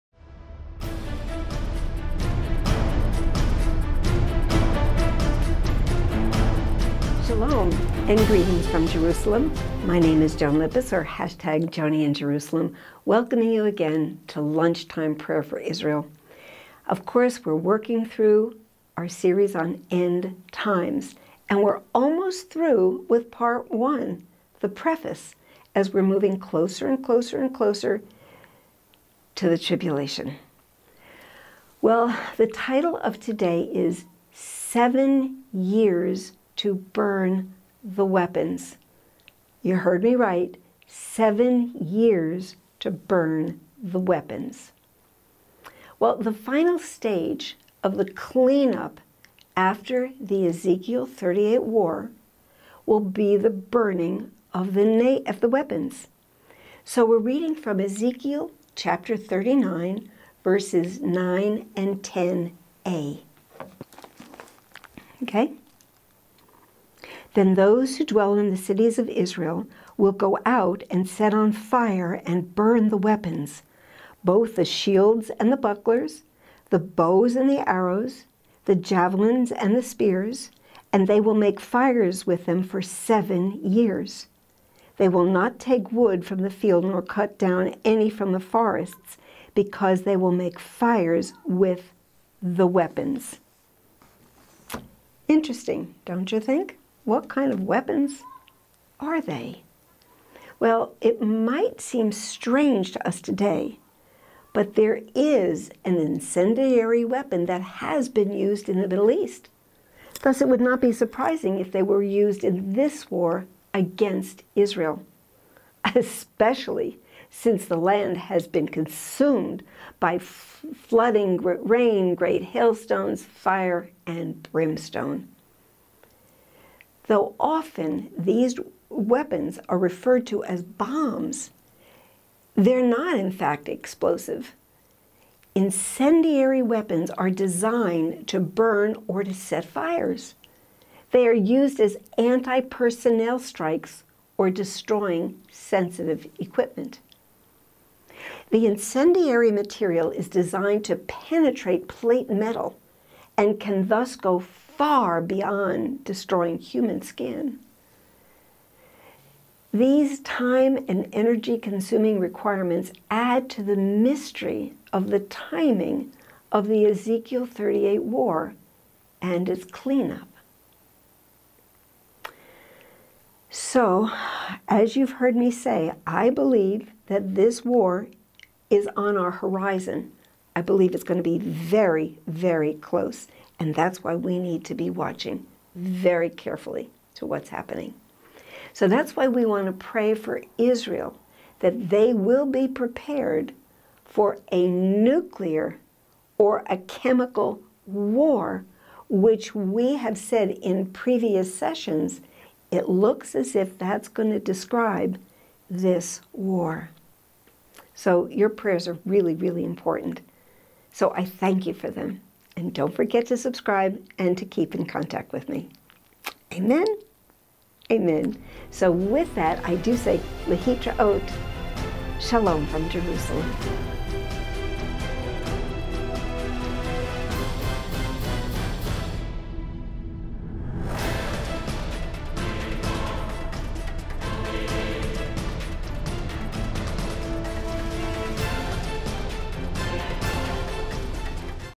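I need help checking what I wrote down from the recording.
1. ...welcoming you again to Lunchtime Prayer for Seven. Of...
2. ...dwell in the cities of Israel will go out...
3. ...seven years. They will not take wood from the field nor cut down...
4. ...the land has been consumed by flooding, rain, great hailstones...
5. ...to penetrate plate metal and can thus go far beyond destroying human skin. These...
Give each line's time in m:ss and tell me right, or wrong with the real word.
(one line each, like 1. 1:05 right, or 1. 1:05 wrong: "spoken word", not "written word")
1. 0:13 wrong: "Israel", not "Seven"
2. 1:08 right
3. 1:22 right
4. 1:57 right
5. 2:30 right.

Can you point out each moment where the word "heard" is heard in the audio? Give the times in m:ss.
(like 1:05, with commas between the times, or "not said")
0:39, 2:55.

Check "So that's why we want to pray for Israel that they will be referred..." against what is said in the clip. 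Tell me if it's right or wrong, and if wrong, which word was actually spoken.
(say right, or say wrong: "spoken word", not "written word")
wrong: "prepared", not "referred".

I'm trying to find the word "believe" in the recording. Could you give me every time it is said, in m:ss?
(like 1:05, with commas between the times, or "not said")
2:56, 3:00.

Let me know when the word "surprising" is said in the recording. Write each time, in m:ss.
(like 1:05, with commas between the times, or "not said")
1:50.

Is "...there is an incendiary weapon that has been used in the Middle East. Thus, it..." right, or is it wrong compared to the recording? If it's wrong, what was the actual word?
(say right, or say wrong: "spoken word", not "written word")
right.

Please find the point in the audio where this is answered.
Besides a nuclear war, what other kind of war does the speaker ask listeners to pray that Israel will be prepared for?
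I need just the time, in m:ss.
3:16.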